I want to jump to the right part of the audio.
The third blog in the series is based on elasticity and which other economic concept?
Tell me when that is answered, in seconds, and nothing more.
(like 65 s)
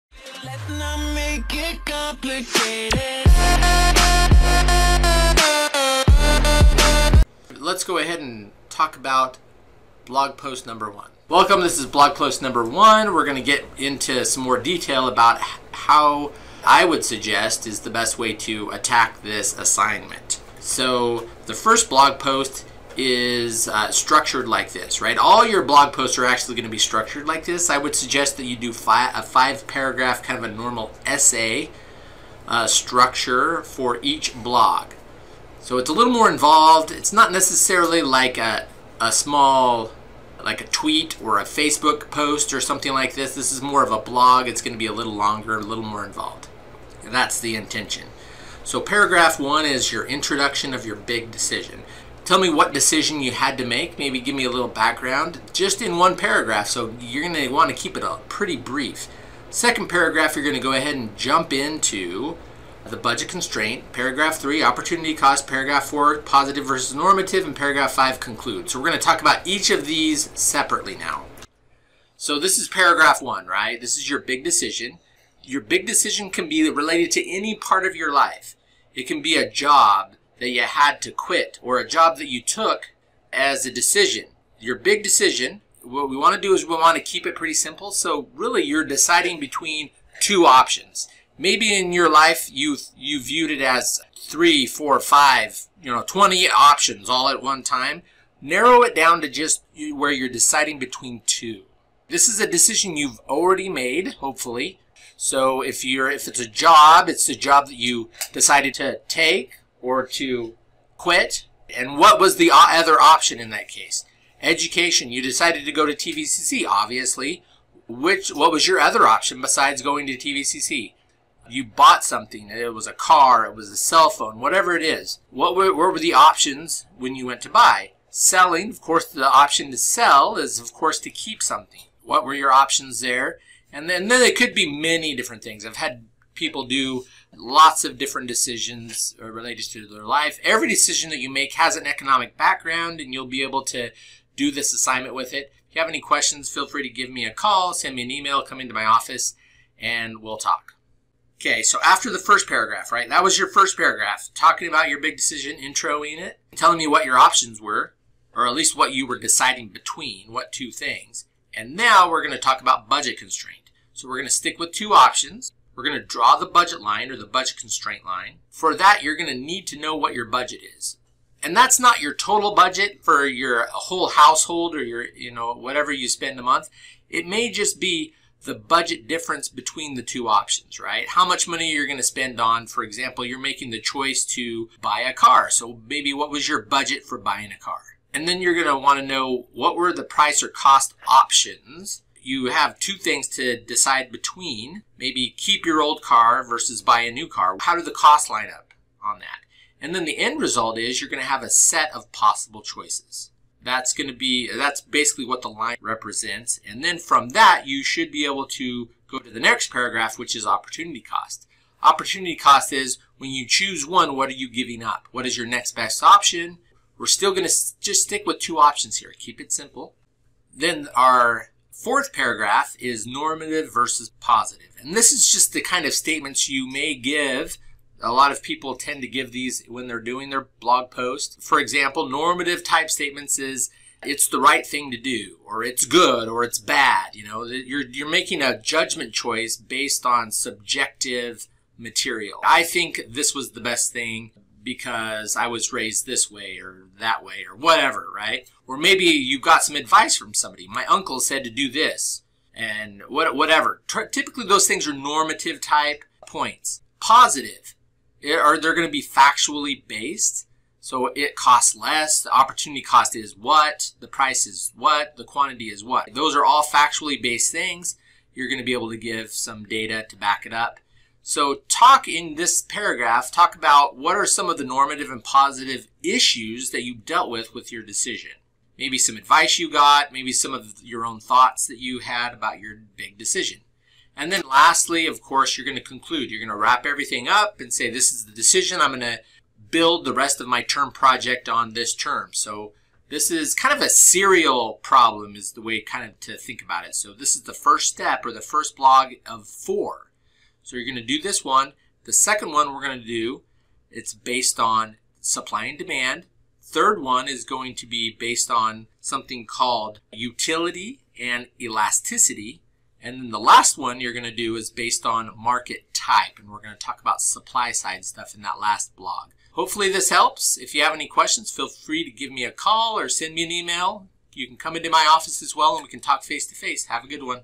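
310 s.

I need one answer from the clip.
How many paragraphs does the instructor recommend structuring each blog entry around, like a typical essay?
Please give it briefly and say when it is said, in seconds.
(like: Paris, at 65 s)
5, at 29 s.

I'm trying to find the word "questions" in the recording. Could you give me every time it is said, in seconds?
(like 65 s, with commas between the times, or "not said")
146 s, 321 s.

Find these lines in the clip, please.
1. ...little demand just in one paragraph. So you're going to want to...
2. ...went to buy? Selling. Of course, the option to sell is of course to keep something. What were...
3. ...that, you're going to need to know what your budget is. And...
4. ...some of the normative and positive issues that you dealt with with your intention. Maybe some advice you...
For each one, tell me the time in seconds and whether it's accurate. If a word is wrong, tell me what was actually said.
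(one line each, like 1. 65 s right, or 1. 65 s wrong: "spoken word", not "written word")
1. 54 s wrong: "background", not "demand"
2. 127 s right
3. 168 s right
4. 274 s wrong: "decision", not "intention".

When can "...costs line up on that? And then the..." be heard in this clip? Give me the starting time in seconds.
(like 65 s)
197 s.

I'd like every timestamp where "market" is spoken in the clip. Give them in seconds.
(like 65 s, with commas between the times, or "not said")
315 s.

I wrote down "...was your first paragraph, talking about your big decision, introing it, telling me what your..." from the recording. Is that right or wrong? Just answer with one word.
right.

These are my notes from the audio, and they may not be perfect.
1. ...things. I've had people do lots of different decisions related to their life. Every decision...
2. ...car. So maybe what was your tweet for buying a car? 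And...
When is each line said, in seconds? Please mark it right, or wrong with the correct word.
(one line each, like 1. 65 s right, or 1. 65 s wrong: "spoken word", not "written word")
1. 135 s right
2. 185 s wrong: "budget", not "tweet".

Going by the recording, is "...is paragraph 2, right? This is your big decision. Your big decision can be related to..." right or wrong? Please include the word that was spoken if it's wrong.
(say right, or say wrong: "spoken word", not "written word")
wrong: "1", not "2".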